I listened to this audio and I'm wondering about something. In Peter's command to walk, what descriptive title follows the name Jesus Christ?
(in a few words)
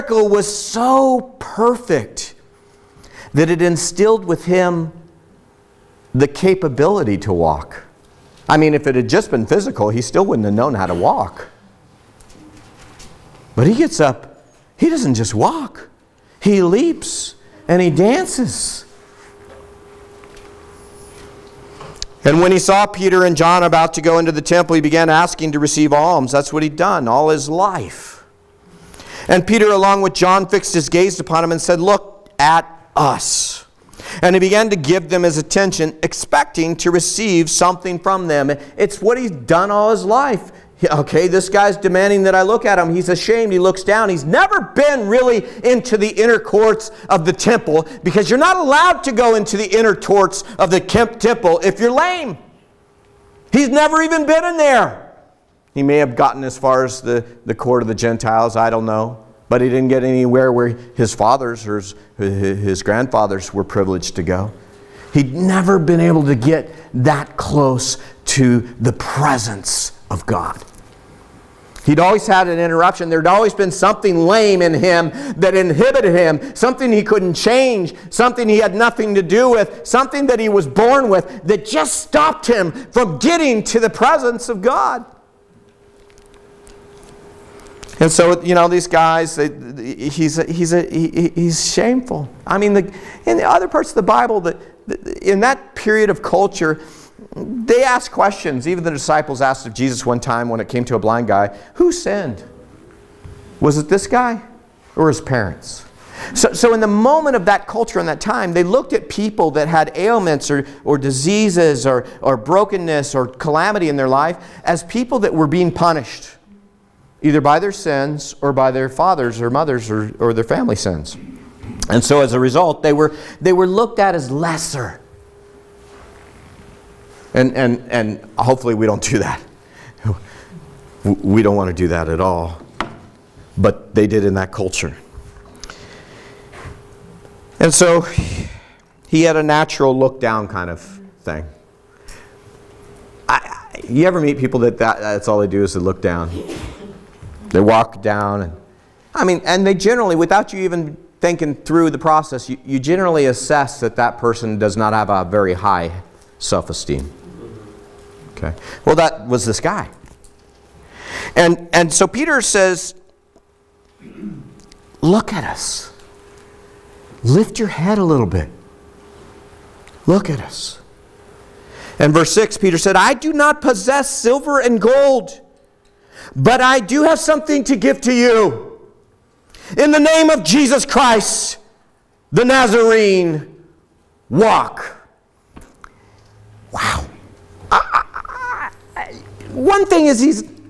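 The Nazarene.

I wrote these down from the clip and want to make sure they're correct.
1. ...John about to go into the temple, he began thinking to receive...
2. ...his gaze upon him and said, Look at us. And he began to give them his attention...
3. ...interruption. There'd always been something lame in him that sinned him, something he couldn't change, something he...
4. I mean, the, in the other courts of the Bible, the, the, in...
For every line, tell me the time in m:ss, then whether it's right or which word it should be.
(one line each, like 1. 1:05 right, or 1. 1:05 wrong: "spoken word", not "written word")
1. 0:23 wrong: "asking", not "thinking"
2. 0:30 right
3. 1:12 wrong: "inhibited", not "sinned"
4. 1:32 wrong: "parts", not "courts".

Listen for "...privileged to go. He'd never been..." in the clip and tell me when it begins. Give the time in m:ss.
1:03.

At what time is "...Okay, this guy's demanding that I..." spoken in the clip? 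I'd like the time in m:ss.
0:40.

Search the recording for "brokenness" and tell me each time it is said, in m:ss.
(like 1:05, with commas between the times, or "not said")
1:52.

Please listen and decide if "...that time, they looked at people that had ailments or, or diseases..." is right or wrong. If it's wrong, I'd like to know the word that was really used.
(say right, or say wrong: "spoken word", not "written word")
right.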